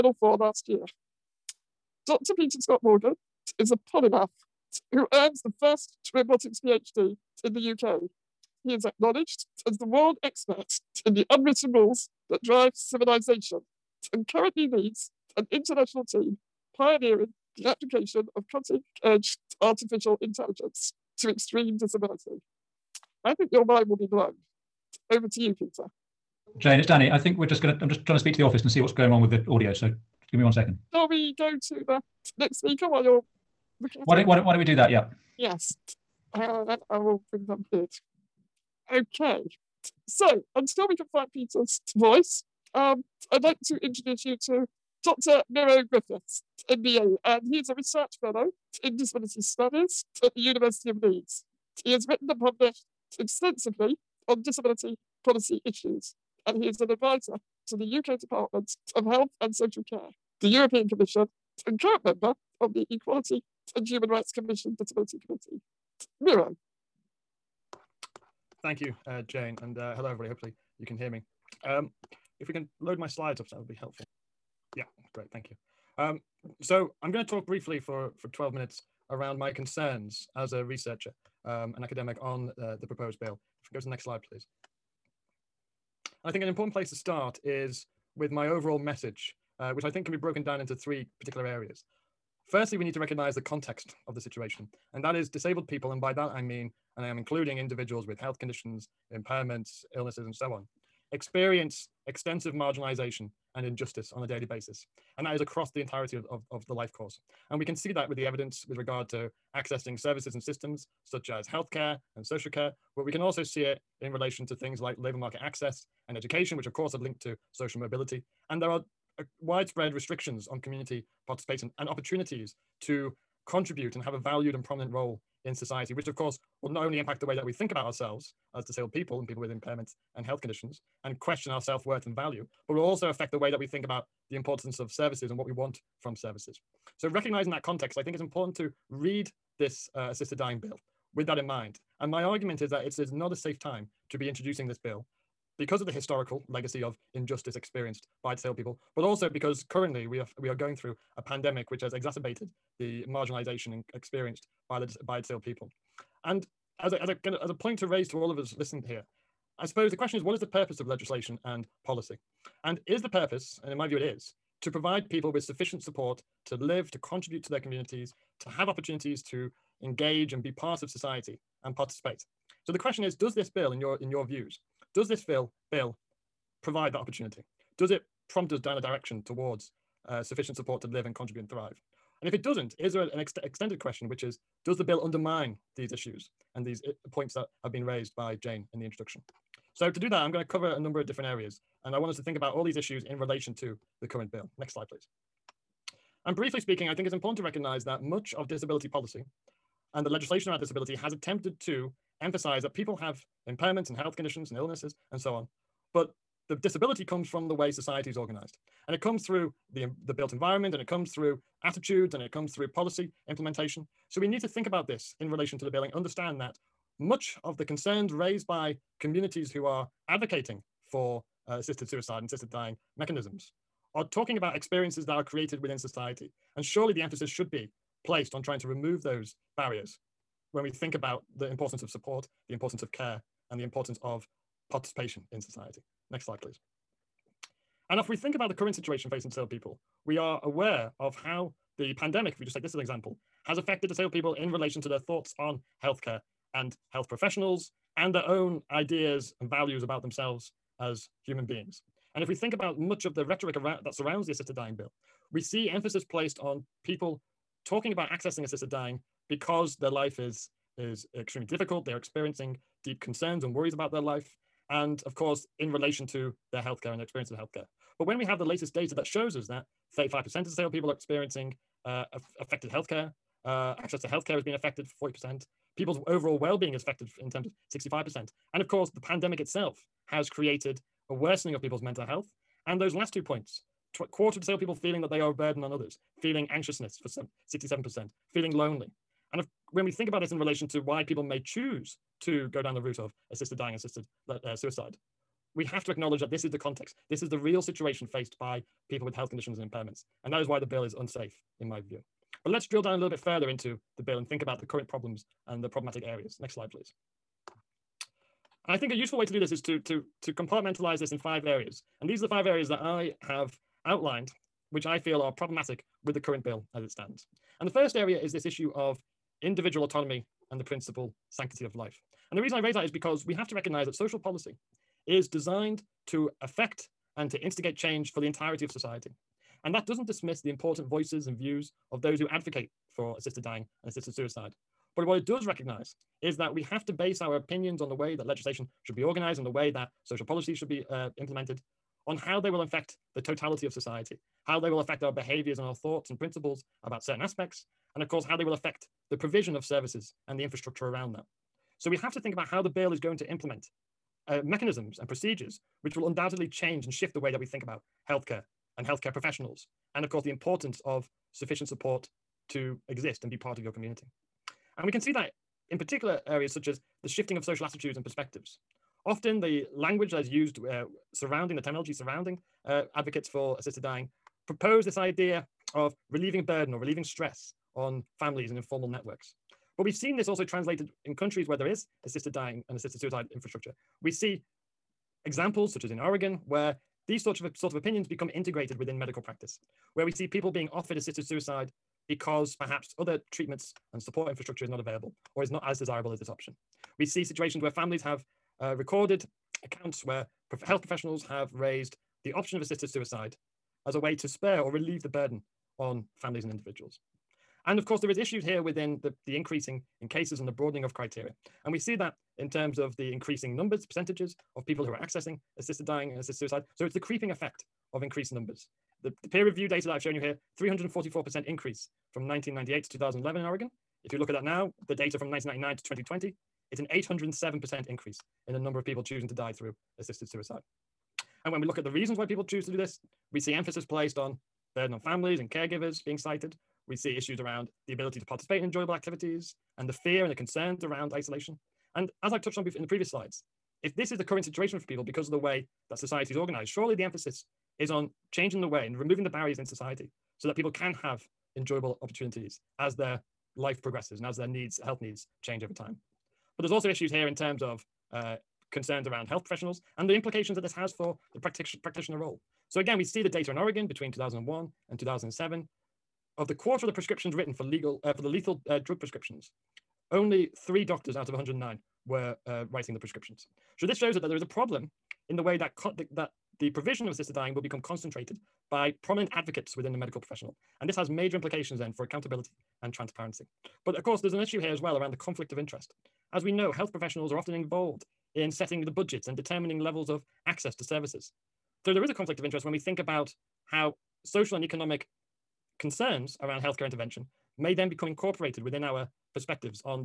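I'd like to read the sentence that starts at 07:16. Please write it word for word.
We see issues around the ability to participate in enjoyable activities and the fear and the concerns around isolation.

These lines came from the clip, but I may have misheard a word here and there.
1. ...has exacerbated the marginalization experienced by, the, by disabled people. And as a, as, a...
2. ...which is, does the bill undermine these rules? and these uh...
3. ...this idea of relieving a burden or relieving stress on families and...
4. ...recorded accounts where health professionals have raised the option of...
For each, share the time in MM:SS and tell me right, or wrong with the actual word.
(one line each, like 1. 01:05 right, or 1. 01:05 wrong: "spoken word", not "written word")
1. 02:31 right
2. 03:04 wrong: "issues", not "rules"
3. 06:14 right
4. 06:38 right.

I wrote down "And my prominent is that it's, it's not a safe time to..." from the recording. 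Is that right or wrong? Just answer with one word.
wrong.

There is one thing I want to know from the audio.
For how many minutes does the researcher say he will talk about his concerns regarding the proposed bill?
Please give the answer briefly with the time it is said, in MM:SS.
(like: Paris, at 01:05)
12, at 01:18.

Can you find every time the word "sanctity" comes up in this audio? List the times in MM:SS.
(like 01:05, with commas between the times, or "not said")
05:21.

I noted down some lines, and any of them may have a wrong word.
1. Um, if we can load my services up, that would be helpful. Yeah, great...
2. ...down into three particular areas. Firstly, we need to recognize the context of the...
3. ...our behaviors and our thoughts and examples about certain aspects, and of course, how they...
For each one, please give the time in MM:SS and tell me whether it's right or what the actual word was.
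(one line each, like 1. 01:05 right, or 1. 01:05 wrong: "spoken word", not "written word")
1. 01:11 wrong: "slides", not "services"
2. 01:30 right
3. 05:45 wrong: "principles", not "examples".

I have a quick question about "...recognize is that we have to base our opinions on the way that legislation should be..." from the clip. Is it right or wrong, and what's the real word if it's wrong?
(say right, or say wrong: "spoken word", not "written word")
right.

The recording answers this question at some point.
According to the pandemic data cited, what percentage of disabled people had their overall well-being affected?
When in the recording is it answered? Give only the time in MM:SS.
04:37.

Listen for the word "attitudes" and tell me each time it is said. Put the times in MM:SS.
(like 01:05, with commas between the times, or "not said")
03:31, 06:07.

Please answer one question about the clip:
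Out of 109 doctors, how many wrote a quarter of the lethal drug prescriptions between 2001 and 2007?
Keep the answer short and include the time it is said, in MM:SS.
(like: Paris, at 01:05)
3, at 07:50.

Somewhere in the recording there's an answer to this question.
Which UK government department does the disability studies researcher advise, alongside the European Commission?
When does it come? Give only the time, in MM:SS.
00:58.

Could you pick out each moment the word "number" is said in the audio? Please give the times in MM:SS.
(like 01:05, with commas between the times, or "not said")
03:10, 06:53, 06:58, 07:08.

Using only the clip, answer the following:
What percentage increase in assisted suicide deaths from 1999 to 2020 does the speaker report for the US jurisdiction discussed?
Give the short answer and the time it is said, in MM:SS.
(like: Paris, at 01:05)
807%, at 07:06.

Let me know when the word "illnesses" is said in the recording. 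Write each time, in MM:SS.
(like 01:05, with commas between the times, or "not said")
01:39, 03:24.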